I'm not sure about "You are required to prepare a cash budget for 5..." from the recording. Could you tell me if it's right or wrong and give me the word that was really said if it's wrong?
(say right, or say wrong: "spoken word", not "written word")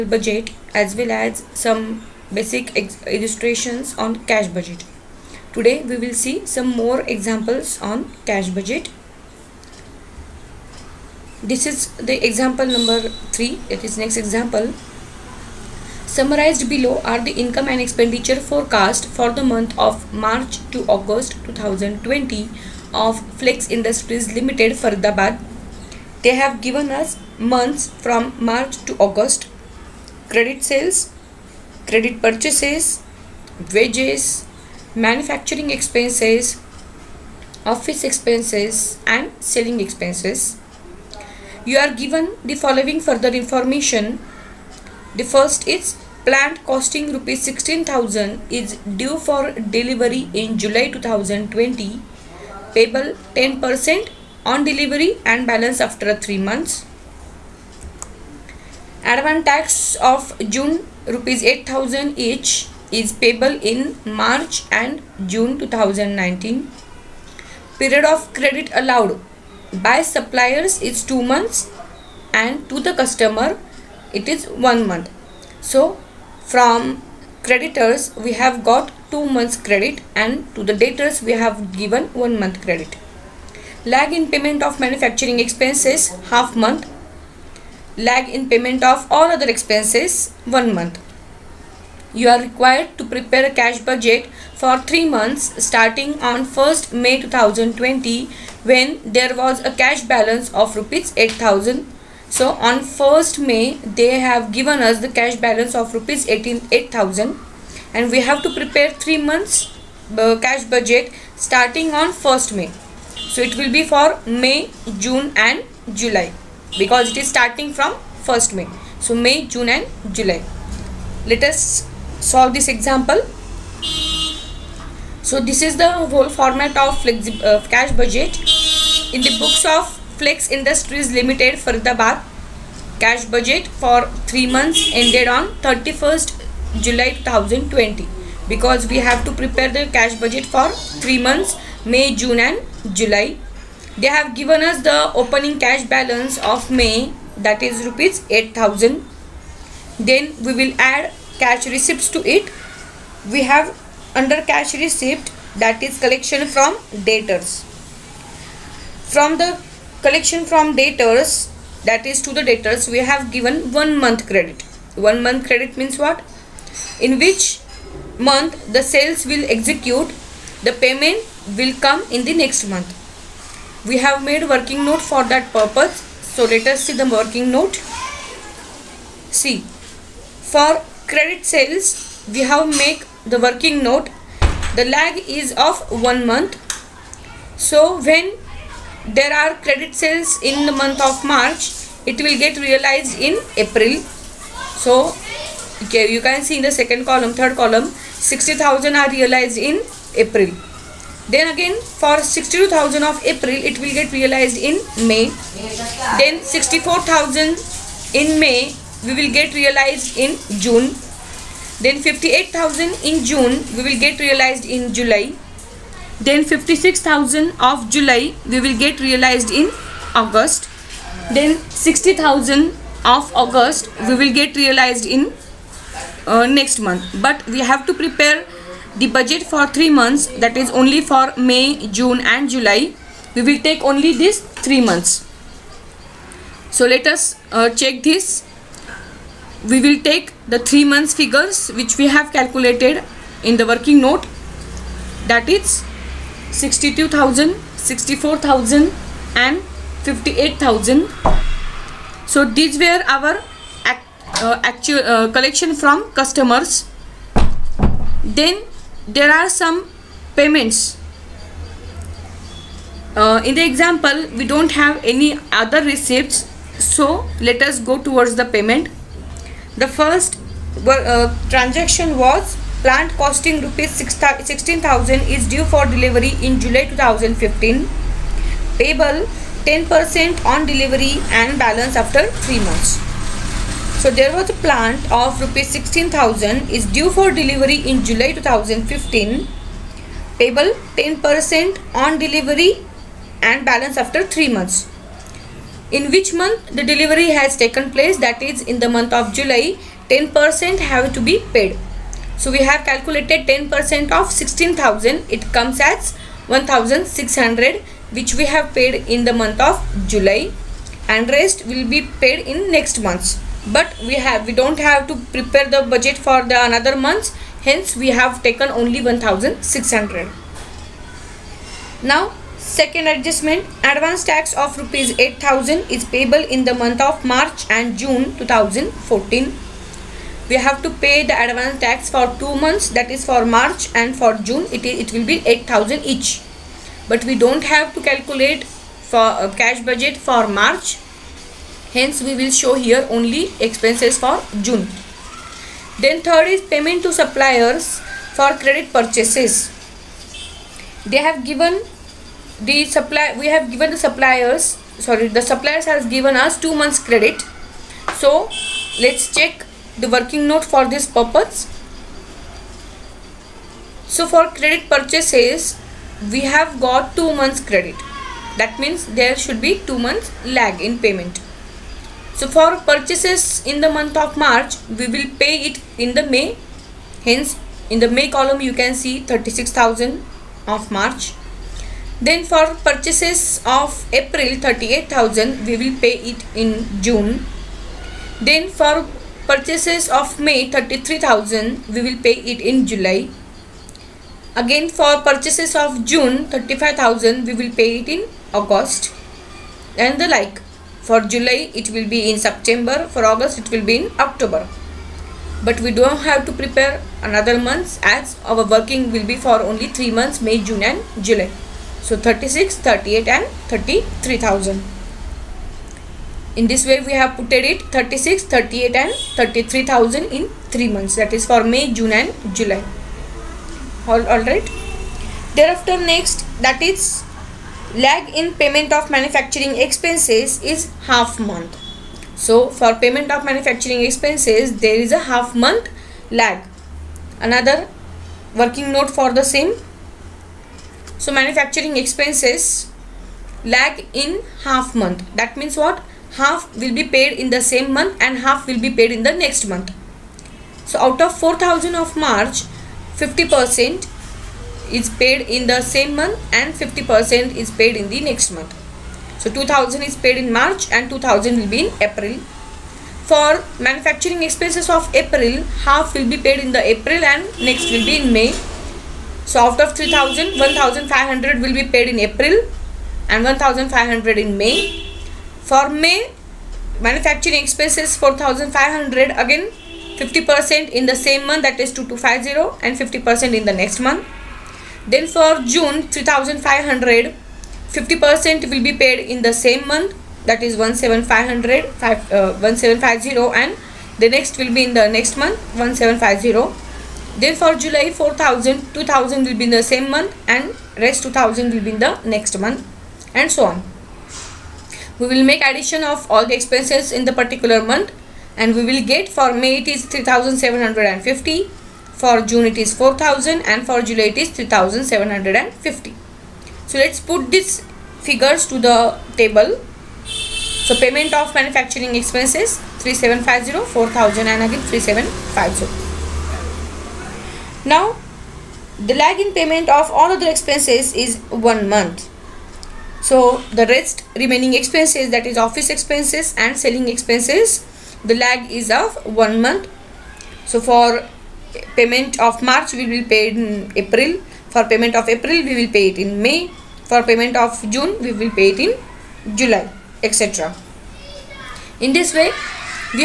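wrong: "3", not "5".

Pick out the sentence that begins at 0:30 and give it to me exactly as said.
Credit sales, credit purchases, wages, manufacturing expenses, office expenses and selling expenses.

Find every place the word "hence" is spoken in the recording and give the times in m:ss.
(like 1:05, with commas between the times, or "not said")
5:17, 5:41, 6:17.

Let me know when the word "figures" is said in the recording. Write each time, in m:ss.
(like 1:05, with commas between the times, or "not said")
4:01, 8:38.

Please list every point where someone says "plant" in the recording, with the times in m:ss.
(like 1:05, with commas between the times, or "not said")
0:46, 4:32, 4:44.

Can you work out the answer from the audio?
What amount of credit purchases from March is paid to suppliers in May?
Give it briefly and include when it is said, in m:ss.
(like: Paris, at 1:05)
36,000, at 6:19.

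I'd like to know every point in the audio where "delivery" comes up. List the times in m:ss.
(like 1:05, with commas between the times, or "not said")
0:49, 0:54, 4:35, 4:40, 4:47, 4:52, 4:56.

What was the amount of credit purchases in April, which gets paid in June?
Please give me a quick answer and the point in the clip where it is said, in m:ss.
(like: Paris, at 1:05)
38,000, at 6:24.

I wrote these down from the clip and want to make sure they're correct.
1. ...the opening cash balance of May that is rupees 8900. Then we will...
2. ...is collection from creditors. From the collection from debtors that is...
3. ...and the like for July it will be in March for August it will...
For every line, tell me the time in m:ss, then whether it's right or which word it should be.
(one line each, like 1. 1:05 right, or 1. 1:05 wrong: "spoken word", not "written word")
1. 2:24 wrong: "8000", not "8900"
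2. 2:35 wrong: "debtors", not "creditors"
3. 6:39 wrong: "September", not "March".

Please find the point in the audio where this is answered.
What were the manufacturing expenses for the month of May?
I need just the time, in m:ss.
7:58.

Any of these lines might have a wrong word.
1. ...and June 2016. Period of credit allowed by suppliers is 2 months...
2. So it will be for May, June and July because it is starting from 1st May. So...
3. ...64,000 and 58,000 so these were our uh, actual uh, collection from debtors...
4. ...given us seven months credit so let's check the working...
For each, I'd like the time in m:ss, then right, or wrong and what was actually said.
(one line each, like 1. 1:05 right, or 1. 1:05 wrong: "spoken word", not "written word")
1. 1:04 wrong: "2019", not "2016"
2. 1:53 right
3. 4:07 wrong: "customers", not "debtors"
4. 5:56 wrong: "two", not "seven".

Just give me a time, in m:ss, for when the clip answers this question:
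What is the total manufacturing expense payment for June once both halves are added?
8:32.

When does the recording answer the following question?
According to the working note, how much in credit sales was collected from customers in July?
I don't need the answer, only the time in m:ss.
3:32.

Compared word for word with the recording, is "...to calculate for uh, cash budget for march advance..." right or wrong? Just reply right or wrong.
wrong.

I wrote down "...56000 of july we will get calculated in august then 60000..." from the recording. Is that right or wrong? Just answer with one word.
wrong.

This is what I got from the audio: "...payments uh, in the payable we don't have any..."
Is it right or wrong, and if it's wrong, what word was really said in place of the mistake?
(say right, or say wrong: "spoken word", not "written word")
wrong: "example", not "payable".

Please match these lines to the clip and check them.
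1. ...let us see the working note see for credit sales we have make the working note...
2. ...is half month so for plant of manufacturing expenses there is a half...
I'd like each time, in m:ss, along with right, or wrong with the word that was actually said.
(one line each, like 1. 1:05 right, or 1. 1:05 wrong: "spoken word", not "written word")
1. 2:56 right
2. 7:10 wrong: "payment", not "plant".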